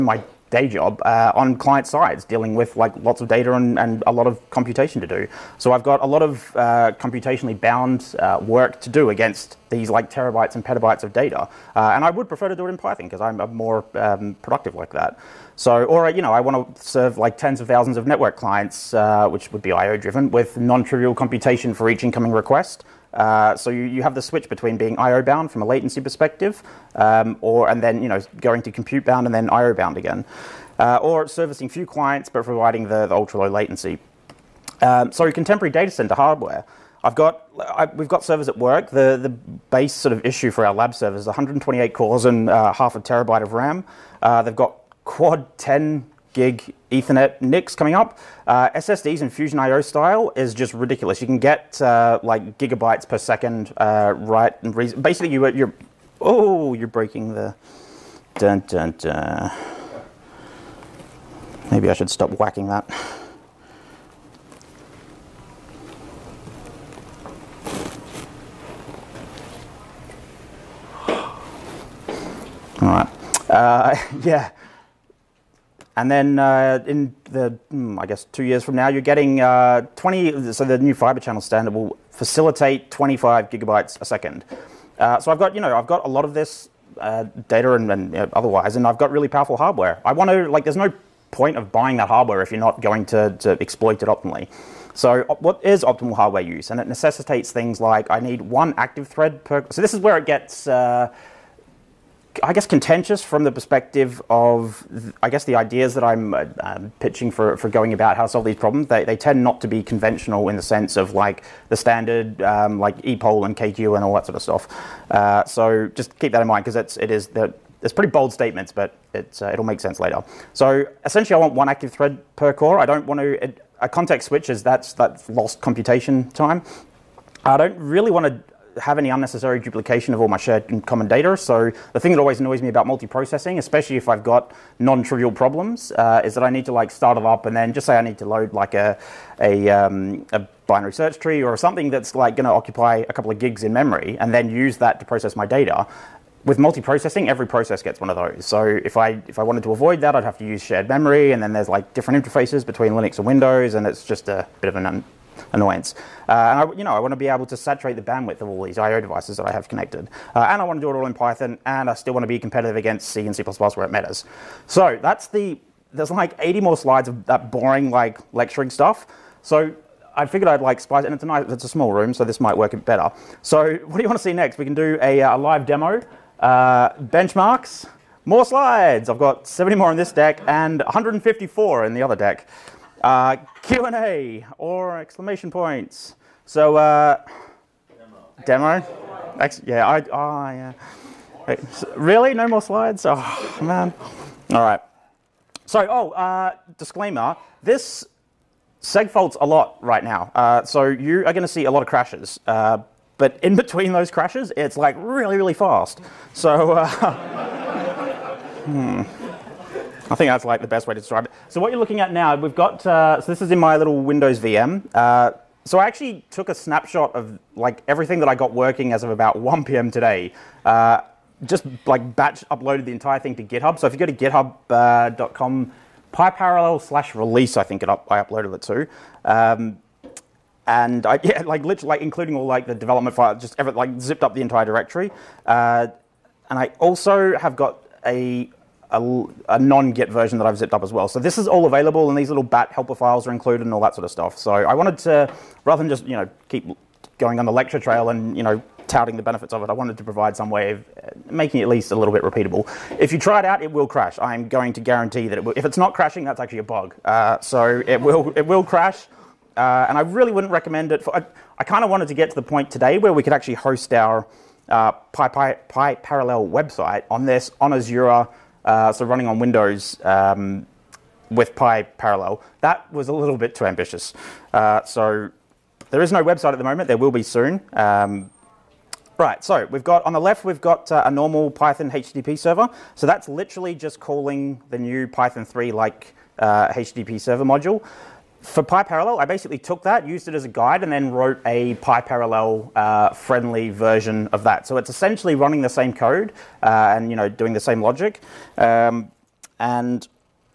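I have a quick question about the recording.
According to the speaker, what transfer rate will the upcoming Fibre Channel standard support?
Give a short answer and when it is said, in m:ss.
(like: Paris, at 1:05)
25 gigabytes a second, at 1:22.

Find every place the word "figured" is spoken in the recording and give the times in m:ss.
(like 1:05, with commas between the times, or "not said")
2:50.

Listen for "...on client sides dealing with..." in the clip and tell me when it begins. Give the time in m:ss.
0:01.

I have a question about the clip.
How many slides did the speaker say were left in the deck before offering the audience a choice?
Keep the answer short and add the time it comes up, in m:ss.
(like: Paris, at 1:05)
70, at 2:59.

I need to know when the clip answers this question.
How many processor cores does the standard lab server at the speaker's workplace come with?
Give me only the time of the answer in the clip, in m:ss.
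0:41.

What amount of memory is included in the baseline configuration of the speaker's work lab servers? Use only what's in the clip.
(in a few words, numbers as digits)
half a terabyte.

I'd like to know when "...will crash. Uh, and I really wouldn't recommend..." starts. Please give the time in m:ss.
4:18.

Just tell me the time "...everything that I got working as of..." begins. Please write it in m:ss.
3:37.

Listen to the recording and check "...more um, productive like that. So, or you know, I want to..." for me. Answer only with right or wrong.
right.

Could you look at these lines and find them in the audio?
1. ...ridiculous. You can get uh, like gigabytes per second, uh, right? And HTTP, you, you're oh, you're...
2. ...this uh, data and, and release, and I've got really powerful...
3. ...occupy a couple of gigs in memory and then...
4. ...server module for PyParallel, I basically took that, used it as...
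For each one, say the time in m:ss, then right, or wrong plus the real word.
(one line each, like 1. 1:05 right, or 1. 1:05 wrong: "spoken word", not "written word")
1. 0:50 wrong: "Basically", not "HTTP"
2. 1:26 wrong: "otherwise", not "release"
3. 2:22 right
4. 4:47 right.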